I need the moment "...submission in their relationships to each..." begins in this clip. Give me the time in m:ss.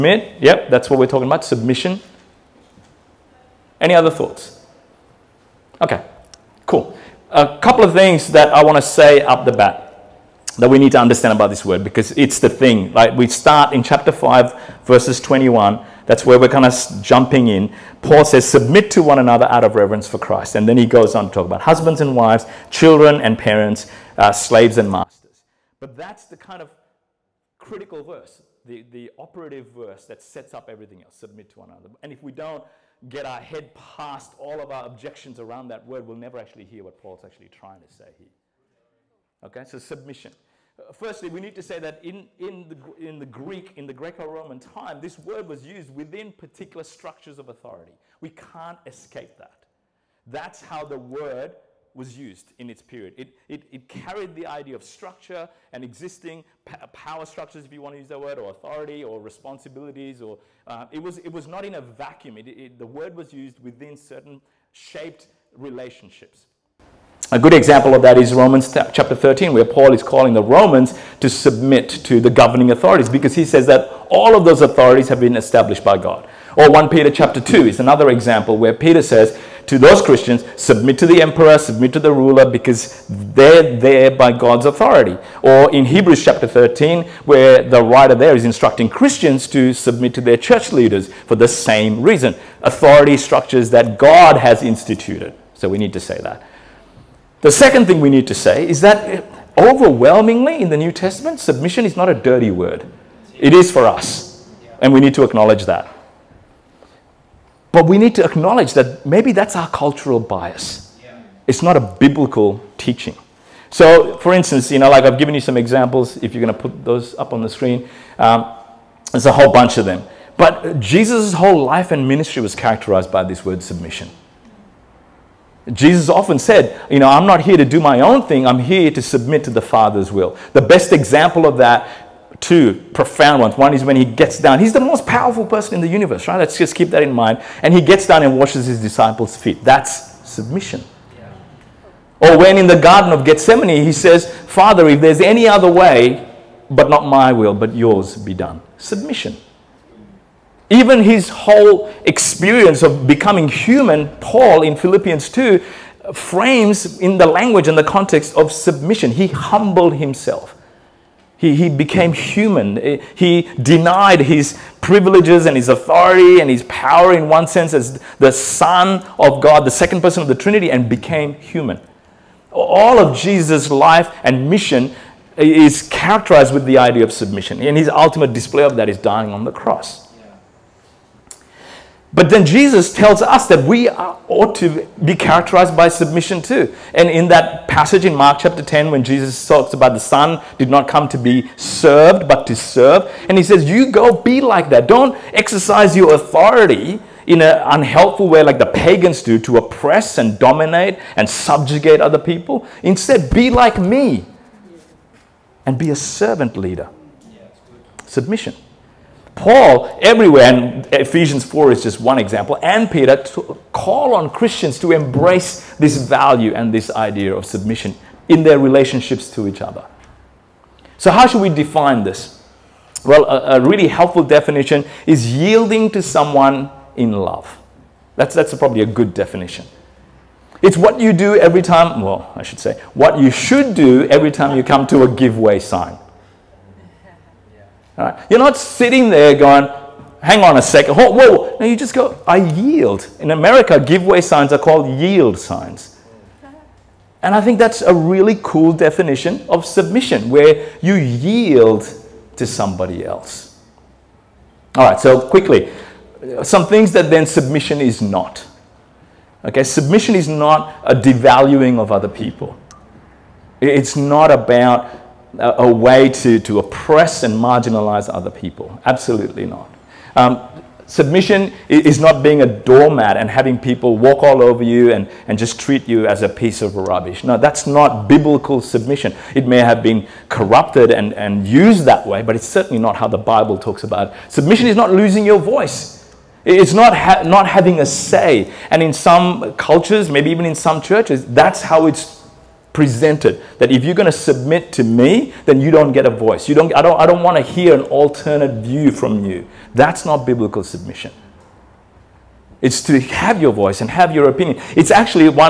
3:37.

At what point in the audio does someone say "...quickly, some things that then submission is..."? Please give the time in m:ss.
4:15.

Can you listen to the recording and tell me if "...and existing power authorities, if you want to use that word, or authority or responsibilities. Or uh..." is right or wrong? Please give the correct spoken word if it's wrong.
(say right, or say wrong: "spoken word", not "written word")
wrong: "structures", not "authorities".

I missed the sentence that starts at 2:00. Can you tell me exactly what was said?
But Jesus' whole life and ministry was characterized by this word submission.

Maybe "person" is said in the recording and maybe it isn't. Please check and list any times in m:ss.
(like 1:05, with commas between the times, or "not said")
2:15, 2:50.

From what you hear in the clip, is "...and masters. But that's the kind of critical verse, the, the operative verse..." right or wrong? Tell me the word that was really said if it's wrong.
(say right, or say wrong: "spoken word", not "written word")
right.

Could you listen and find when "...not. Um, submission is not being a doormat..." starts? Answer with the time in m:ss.
4:29.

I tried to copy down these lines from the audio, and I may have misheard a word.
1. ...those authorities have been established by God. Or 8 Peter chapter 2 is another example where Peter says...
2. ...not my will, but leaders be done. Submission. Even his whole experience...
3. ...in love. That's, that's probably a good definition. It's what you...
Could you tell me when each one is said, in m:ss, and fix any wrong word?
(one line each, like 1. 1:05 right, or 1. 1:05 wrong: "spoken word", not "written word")
1. 1:14 wrong: "1", not "8"
2. 2:26 wrong: "yours", not "leaders"
3. 3:46 right.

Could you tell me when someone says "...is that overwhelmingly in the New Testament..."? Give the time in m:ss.
1:38.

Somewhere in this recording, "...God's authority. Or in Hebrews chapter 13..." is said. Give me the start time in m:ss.
1:24.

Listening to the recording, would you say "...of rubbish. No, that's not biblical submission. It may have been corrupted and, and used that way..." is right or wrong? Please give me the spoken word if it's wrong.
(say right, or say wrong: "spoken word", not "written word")
right.